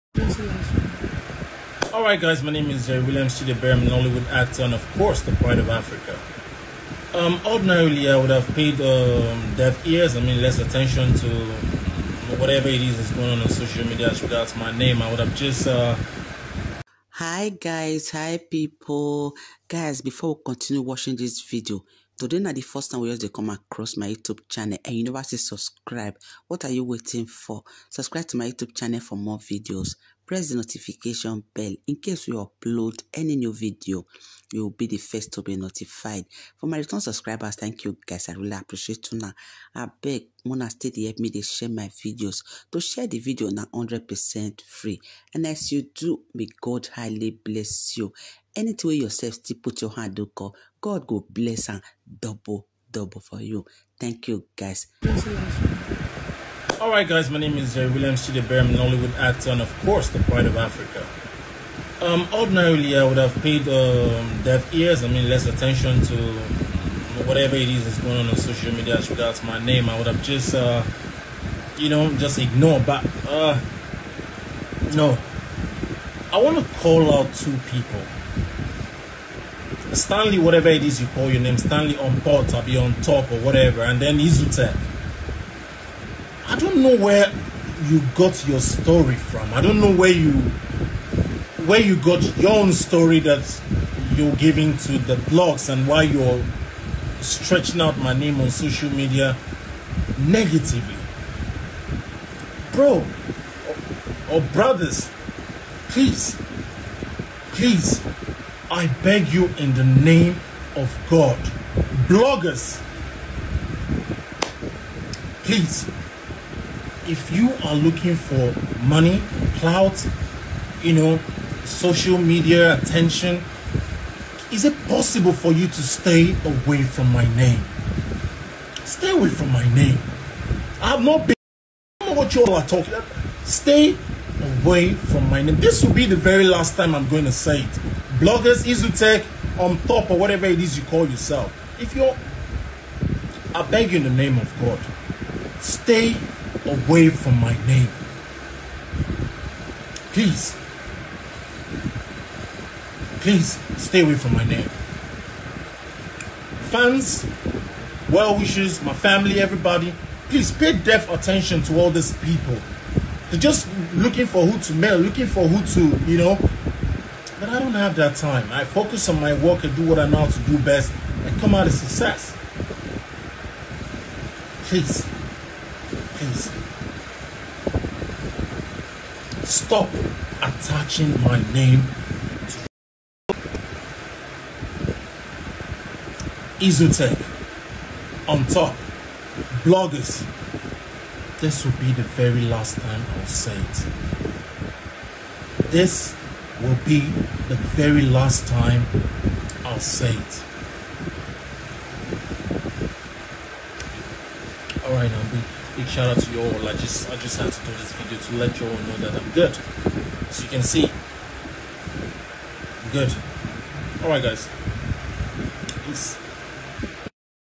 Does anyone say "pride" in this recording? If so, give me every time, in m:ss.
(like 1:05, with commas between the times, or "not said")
0:05, 1:00.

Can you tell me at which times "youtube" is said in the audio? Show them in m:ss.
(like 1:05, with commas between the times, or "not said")
0:24, 0:28.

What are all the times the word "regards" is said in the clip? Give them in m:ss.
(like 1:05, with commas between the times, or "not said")
0:14, 1:09.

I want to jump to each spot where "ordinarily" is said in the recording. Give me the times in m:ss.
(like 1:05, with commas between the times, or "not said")
0:07, 1:02.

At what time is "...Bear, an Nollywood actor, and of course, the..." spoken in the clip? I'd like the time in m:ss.
0:58.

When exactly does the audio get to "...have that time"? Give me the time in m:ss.
2:47.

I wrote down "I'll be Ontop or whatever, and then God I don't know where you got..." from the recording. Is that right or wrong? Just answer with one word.
wrong.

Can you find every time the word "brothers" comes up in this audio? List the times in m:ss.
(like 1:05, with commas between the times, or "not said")
1:44.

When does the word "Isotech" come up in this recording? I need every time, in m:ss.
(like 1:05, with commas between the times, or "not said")
3:06.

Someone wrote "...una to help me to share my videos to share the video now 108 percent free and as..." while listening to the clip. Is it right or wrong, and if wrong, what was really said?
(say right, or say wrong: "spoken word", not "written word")
wrong: "100", not "108".